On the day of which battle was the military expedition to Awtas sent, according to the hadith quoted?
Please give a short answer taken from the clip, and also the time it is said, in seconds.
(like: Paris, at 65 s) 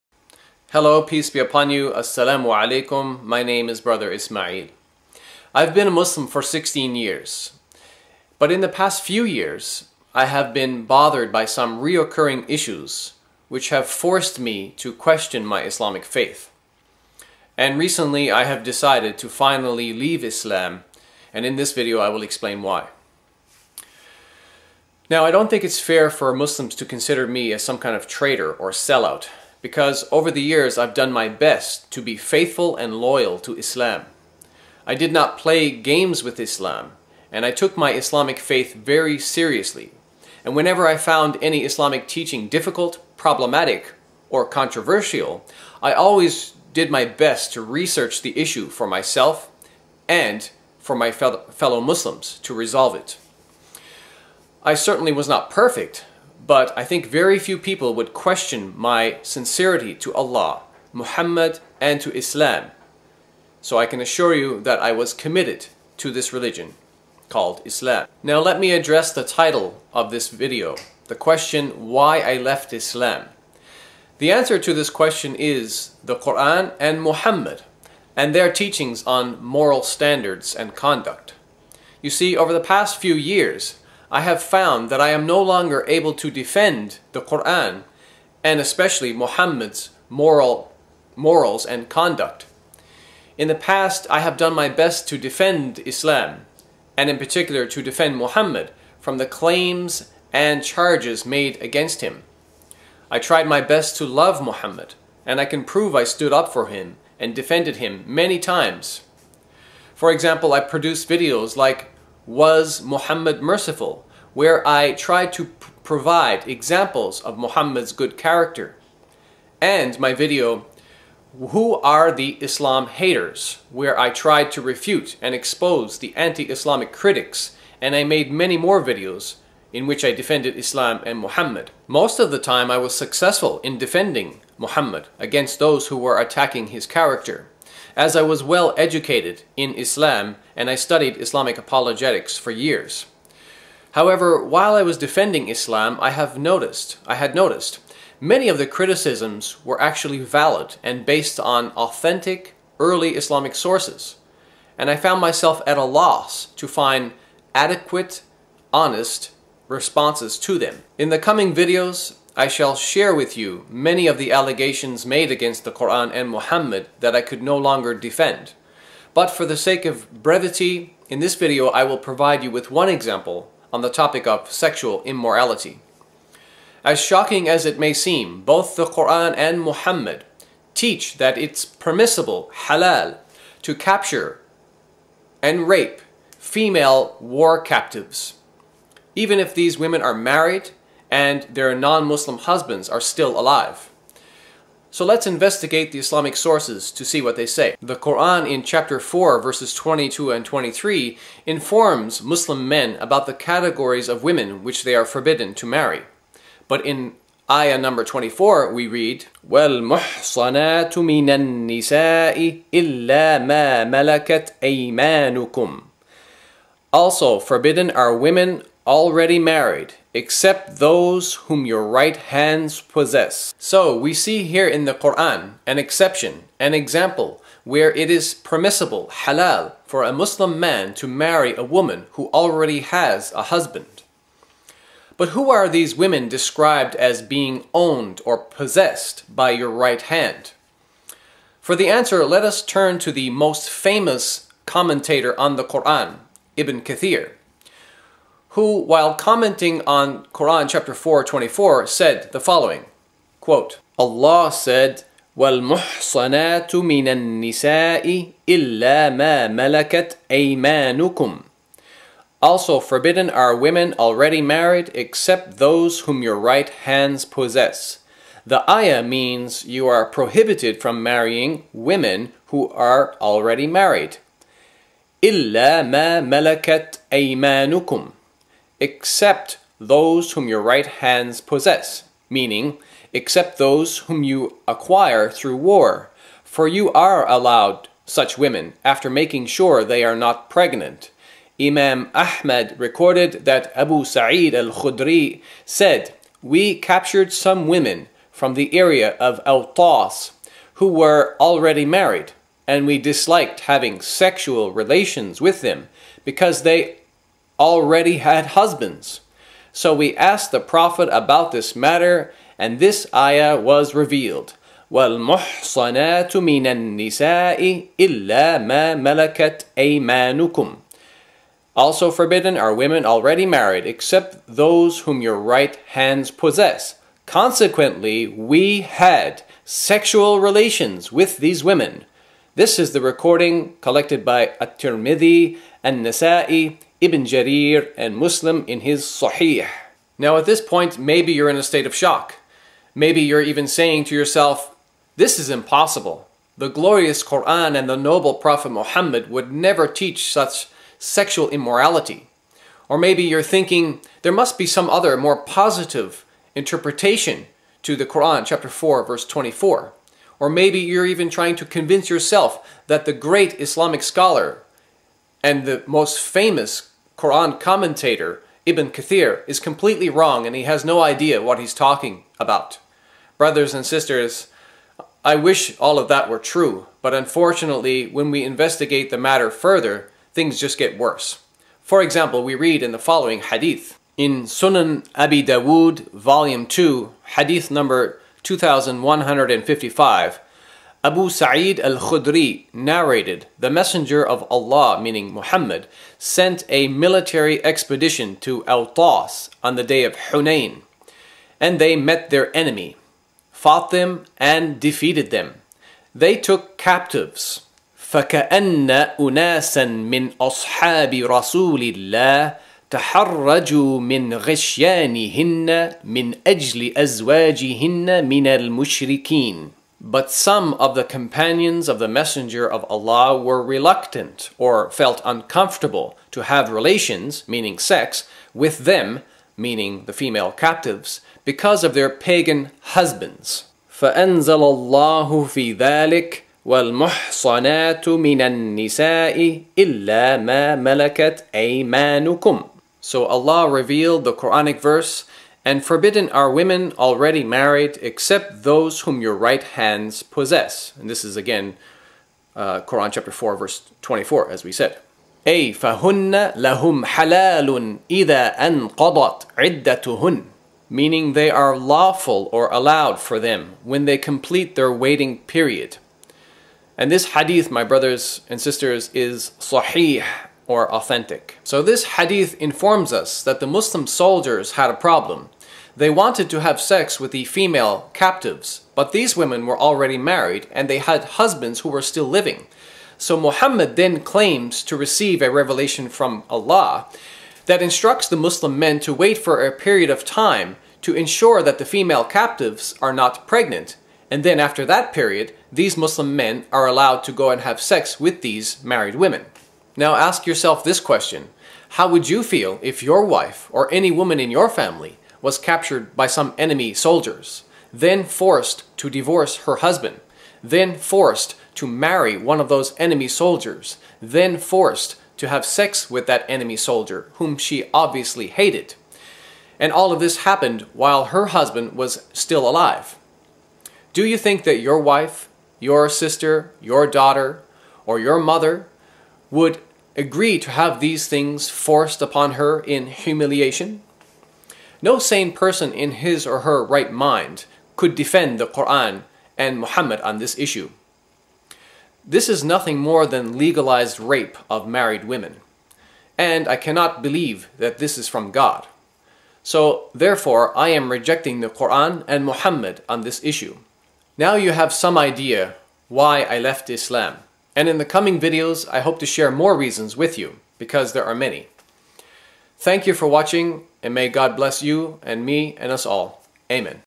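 Hunain, at 400 s.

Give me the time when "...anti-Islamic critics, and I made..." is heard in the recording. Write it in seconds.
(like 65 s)
126 s.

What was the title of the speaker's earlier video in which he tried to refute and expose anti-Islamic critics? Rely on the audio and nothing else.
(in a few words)
Who Are the Islam Haters.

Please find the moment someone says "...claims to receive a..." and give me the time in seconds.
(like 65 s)
484 s.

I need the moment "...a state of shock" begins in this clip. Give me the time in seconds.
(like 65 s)
341 s.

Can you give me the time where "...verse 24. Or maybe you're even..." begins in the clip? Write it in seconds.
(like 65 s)
359 s.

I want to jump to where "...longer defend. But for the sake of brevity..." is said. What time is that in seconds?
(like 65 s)
167 s.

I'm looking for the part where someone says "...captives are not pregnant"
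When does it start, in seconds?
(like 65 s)
492 s.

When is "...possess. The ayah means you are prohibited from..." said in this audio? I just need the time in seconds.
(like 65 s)
267 s.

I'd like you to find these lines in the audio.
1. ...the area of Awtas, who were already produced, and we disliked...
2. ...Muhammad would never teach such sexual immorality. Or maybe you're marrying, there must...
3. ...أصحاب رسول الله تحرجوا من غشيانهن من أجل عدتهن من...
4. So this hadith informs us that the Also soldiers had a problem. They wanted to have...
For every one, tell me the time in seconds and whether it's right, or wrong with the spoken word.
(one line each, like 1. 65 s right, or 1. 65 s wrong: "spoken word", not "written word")
1. 298 s wrong: "married", not "produced"
2. 348 s wrong: "thinking", not "marrying"
3. 410 s wrong: "أزواجهن", not "عدتهن"
4. 471 s wrong: "Muslim", not "Also".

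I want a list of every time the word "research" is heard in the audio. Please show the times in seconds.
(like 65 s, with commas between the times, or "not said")
47 s.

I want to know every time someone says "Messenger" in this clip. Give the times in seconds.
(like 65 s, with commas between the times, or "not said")
393 s, 422 s.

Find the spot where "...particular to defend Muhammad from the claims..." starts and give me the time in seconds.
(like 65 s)
97 s.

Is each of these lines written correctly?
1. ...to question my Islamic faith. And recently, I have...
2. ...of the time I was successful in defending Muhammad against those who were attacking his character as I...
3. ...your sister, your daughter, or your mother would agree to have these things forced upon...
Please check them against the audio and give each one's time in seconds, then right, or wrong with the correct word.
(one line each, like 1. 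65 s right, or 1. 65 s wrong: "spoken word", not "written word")
1. 14 s right
2. 132 s right
3. 525 s right.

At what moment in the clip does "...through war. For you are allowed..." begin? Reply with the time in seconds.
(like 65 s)
285 s.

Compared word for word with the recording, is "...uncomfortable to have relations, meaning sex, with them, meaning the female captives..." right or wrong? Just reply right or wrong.
right.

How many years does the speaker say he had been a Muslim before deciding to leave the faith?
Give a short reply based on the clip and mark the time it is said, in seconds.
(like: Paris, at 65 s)
16, at 6 s.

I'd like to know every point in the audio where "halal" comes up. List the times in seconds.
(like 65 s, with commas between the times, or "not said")
182 s, 229 s.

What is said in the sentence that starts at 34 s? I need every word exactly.
I did not play games with Islam, and I took my Islamic faith very seriously.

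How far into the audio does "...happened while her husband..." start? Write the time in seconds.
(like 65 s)
520 s.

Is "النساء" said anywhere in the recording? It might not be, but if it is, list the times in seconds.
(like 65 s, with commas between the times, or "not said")
211 s, 257 s, 316 s, 438 s.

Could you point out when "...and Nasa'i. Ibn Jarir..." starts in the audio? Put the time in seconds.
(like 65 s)
335 s.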